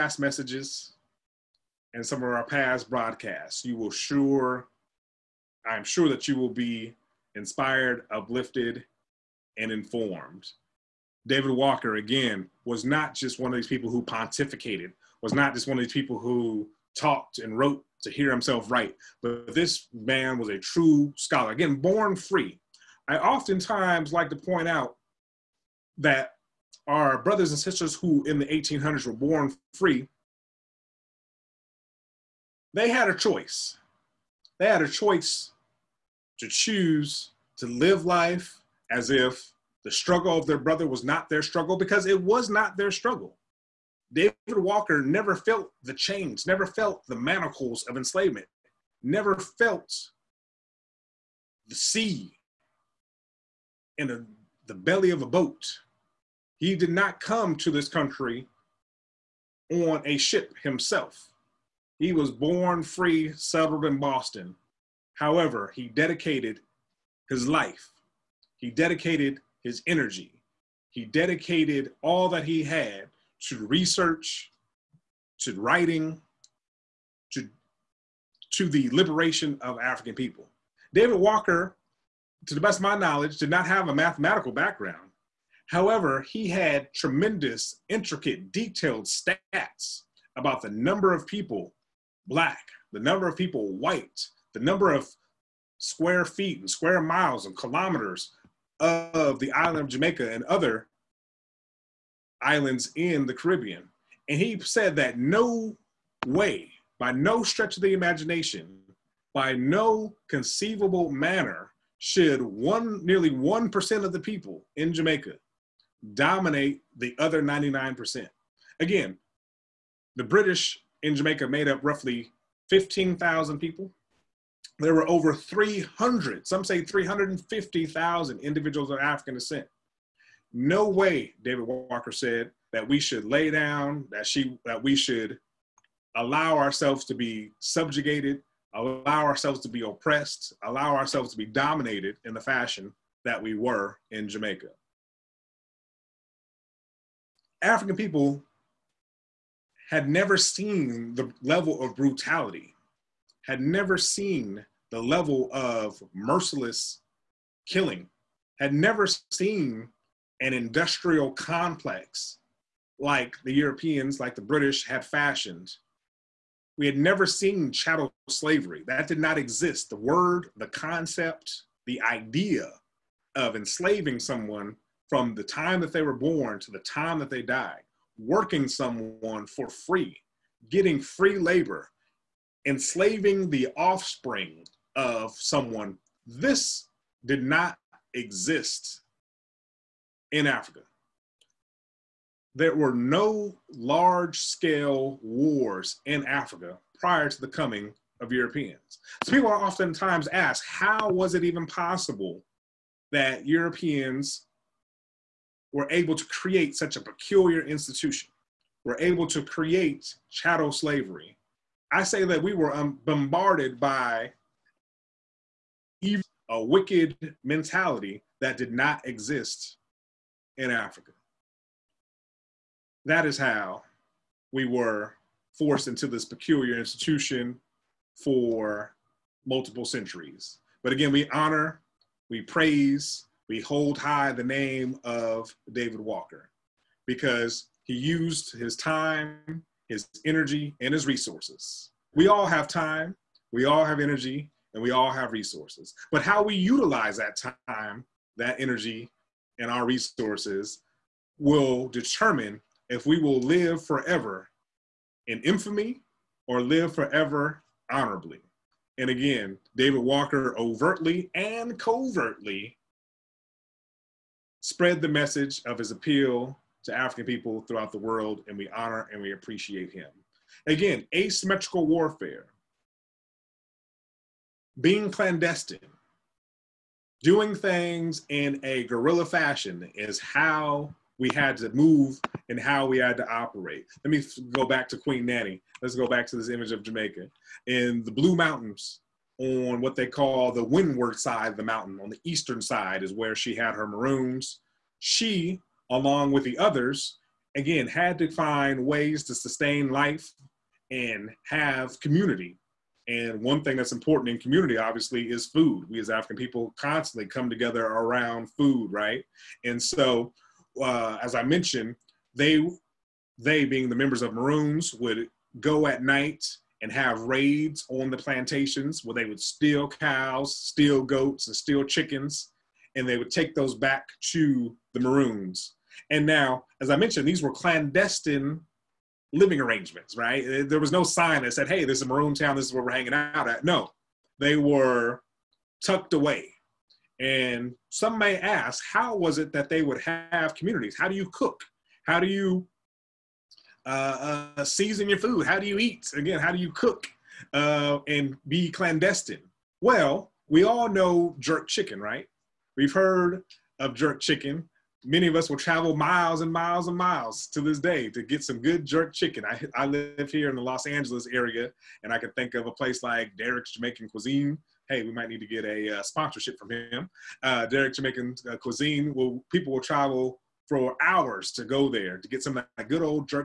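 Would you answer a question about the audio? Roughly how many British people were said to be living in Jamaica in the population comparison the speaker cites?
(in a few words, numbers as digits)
15,000.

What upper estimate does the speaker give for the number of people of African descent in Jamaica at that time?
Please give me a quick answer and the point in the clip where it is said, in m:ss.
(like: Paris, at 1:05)
350,000, at 2:06.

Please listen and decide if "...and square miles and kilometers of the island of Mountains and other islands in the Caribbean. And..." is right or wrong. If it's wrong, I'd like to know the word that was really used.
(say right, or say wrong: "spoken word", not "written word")
wrong: "Jamaica", not "Mountains".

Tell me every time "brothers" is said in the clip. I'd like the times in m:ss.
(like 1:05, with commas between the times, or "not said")
0:27, 0:40.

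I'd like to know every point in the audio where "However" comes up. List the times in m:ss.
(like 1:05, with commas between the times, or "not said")
1:05, 1:25.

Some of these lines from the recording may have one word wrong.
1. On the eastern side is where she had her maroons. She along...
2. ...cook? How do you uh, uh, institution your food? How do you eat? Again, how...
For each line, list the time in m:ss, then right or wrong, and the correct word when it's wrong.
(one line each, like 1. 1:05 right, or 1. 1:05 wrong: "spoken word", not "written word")
1. 4:52 right
2. 5:41 wrong: "season", not "institution".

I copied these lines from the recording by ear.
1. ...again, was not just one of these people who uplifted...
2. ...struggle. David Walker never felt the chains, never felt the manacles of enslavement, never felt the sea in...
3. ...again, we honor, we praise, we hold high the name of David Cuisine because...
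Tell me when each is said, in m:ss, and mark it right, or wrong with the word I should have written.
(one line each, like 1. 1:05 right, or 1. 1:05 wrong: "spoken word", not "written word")
1. 0:11 wrong: "pontificated", not "uplifted"
2. 0:42 right
3. 3:50 wrong: "Walker", not "Cuisine".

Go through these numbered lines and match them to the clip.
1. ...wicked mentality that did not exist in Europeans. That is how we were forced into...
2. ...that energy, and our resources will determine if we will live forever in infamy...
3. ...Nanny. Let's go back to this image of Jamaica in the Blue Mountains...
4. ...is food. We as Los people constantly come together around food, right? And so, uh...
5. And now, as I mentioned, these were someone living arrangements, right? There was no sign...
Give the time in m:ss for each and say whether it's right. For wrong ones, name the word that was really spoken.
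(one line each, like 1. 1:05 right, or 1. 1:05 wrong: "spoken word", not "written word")
1. 3:36 wrong: "Africa", not "Europeans"
2. 4:08 right
3. 4:45 right
4. 5:05 wrong: "African", not "Los"
5. 5:26 wrong: "clandestine", not "someone".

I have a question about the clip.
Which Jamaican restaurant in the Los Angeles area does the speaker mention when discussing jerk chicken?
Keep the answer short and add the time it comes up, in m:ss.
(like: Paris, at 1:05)
Derek's Jamaican Cuisine, at 6:03.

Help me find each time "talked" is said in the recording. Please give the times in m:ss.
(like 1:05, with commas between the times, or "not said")
0:16.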